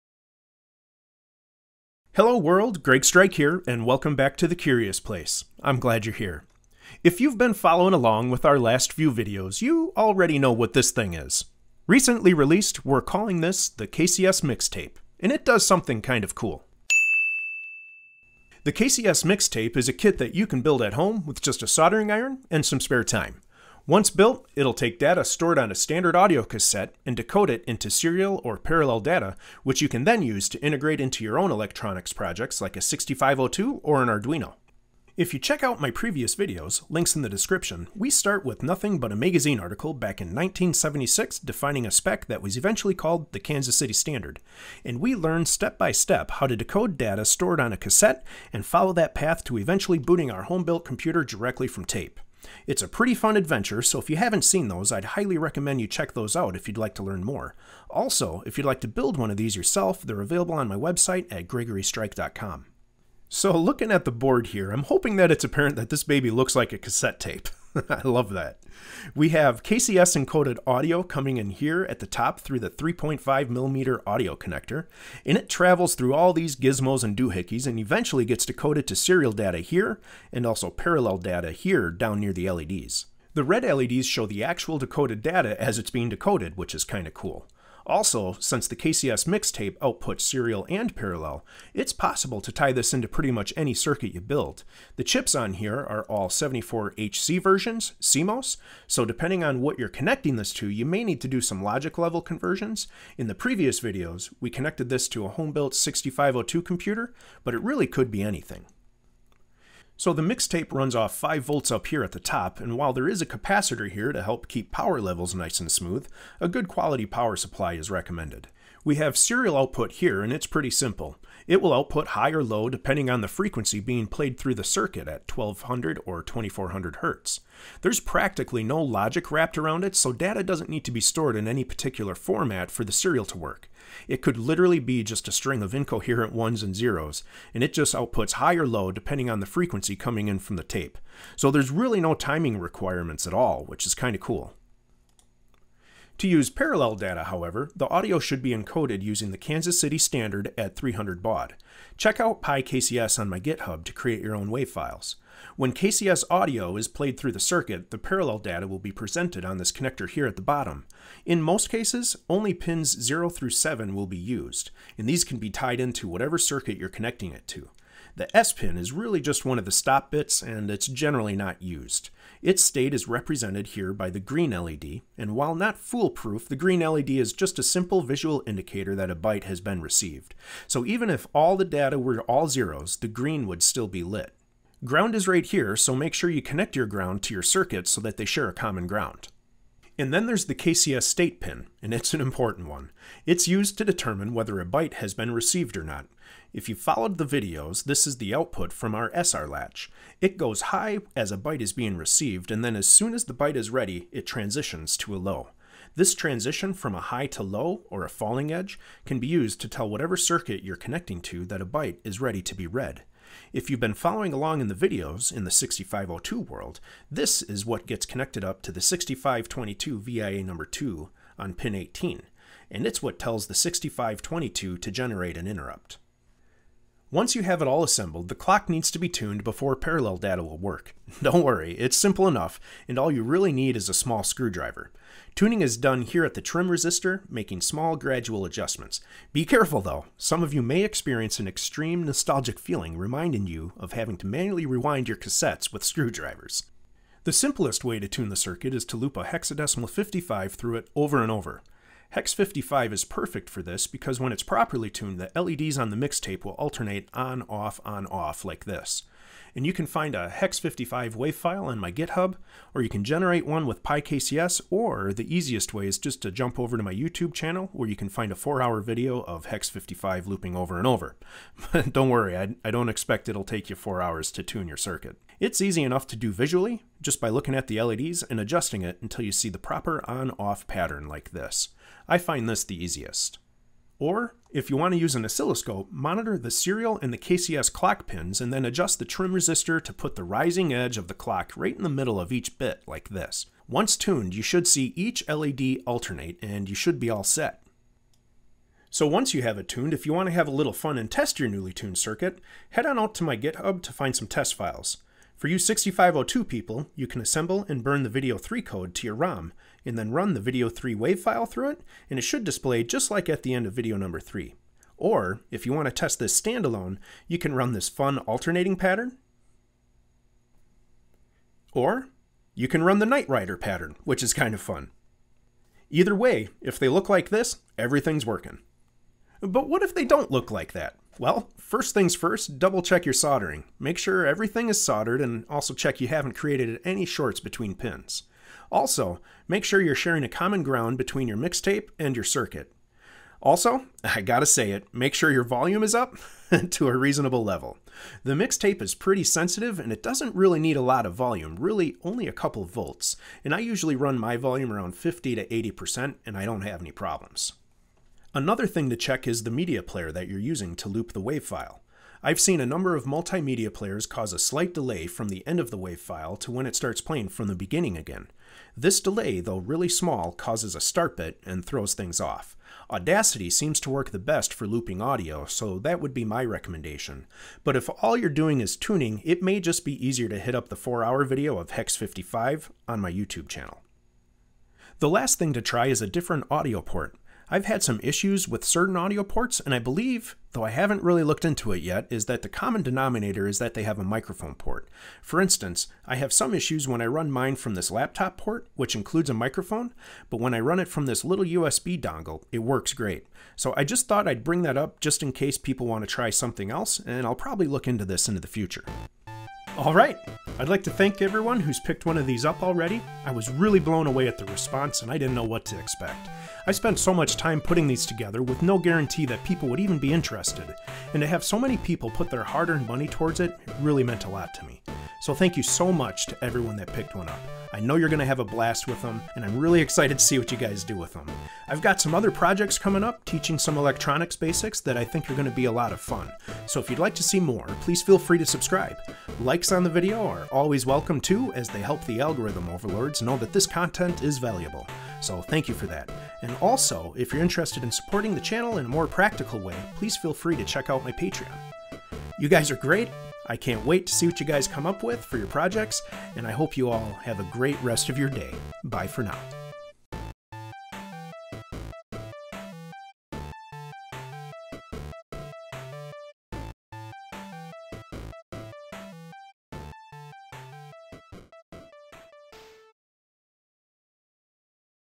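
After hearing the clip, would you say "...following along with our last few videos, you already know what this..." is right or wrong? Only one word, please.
right.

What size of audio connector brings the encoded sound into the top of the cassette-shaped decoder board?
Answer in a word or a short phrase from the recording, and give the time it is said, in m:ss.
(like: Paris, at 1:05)
3.5 millimeter, at 1:12.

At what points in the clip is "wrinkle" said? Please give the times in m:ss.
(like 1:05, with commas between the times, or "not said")
not said.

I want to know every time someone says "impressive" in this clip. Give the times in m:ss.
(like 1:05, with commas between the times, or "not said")
not said.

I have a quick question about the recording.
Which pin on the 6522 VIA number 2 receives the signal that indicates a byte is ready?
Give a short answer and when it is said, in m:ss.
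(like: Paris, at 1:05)
Pin 18, at 3:41.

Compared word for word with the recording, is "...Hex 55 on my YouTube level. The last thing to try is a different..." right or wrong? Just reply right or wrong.
wrong.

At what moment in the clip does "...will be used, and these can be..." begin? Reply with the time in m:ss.
2:43.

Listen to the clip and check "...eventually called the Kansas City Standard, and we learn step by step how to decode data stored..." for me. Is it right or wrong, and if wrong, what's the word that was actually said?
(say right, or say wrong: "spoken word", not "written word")
right.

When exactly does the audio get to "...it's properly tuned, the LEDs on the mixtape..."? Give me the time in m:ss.
4:14.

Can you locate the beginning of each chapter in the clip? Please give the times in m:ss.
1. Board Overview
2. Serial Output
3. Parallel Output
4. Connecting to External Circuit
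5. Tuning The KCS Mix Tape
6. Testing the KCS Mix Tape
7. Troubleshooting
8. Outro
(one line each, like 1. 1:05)
1. 1:02
2. 1:58
3. 2:25
4. 3:03
5. 3:46
6. 4:48
7. 5:29
8. 6:48.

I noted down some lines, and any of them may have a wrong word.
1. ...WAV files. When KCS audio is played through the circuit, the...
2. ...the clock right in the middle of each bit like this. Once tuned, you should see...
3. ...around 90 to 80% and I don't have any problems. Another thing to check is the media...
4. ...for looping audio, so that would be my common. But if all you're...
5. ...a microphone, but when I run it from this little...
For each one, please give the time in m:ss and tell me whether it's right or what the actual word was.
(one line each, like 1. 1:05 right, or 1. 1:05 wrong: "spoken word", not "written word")
1. 2:34 right
2. 4:51 right
3. 5:54 wrong: "50", not "90"
4. 6:14 wrong: "recommendation", not "common"
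5. 6:39 right.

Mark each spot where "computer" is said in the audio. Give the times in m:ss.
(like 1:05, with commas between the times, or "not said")
0:50, 1:46.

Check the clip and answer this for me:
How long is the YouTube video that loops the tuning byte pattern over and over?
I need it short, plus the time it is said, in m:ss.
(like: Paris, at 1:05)
4 hours, at 4:28.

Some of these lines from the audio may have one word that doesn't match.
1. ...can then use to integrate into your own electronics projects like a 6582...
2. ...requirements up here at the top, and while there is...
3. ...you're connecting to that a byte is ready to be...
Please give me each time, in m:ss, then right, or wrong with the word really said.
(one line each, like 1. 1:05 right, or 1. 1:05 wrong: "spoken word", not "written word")
1. 0:29 wrong: "6502", not "6582"
2. 1:51 wrong: "volts", not "requirements"
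3. 3:30 right.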